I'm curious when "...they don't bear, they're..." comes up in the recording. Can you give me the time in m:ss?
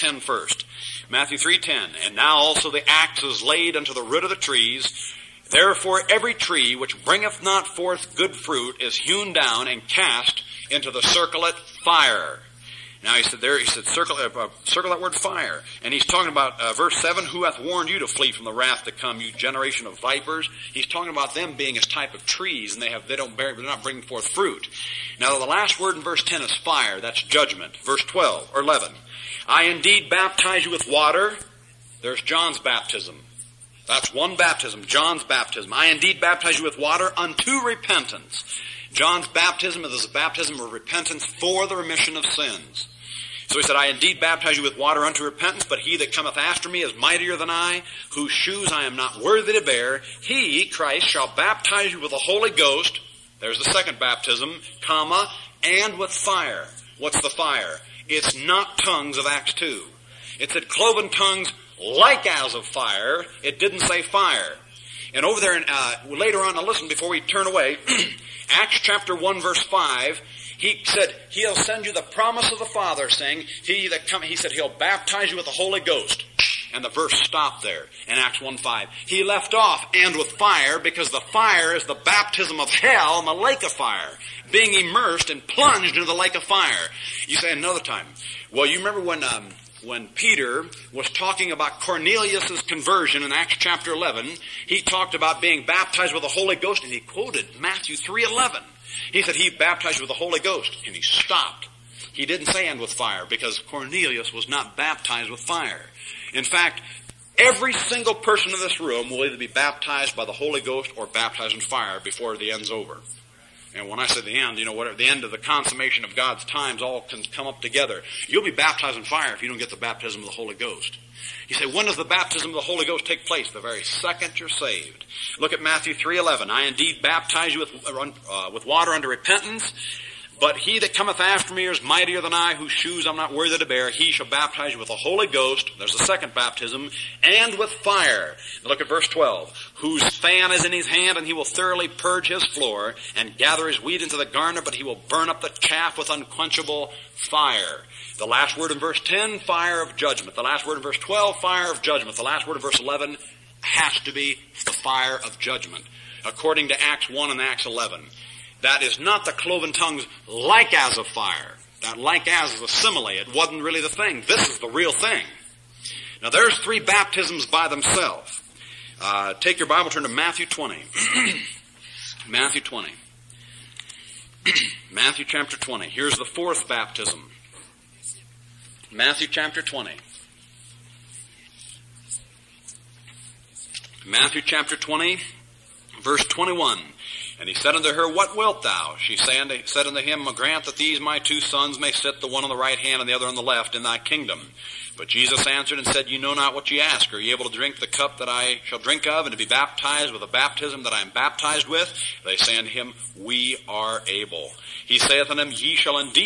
0:23.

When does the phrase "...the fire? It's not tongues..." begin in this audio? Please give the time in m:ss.
0:57.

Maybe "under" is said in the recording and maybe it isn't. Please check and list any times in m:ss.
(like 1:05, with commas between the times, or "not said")
2:08.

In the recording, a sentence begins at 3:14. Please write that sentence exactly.
But Jesus answered and said, You know not what ye ask.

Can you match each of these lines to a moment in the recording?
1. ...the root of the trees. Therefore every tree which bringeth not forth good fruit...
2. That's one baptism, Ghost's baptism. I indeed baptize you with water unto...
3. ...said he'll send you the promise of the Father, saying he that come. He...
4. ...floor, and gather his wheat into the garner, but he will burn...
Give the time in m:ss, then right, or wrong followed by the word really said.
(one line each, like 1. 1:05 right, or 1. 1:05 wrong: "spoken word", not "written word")
1. 0:03 right
2. 0:33 wrong: "John", not "Ghost"
3. 1:10 right
4. 2:22 right.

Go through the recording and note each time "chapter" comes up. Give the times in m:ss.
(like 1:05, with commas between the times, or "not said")
1:08, 1:33, 2:55, 2:59, 3:04.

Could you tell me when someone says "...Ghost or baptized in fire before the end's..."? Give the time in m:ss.
1:50.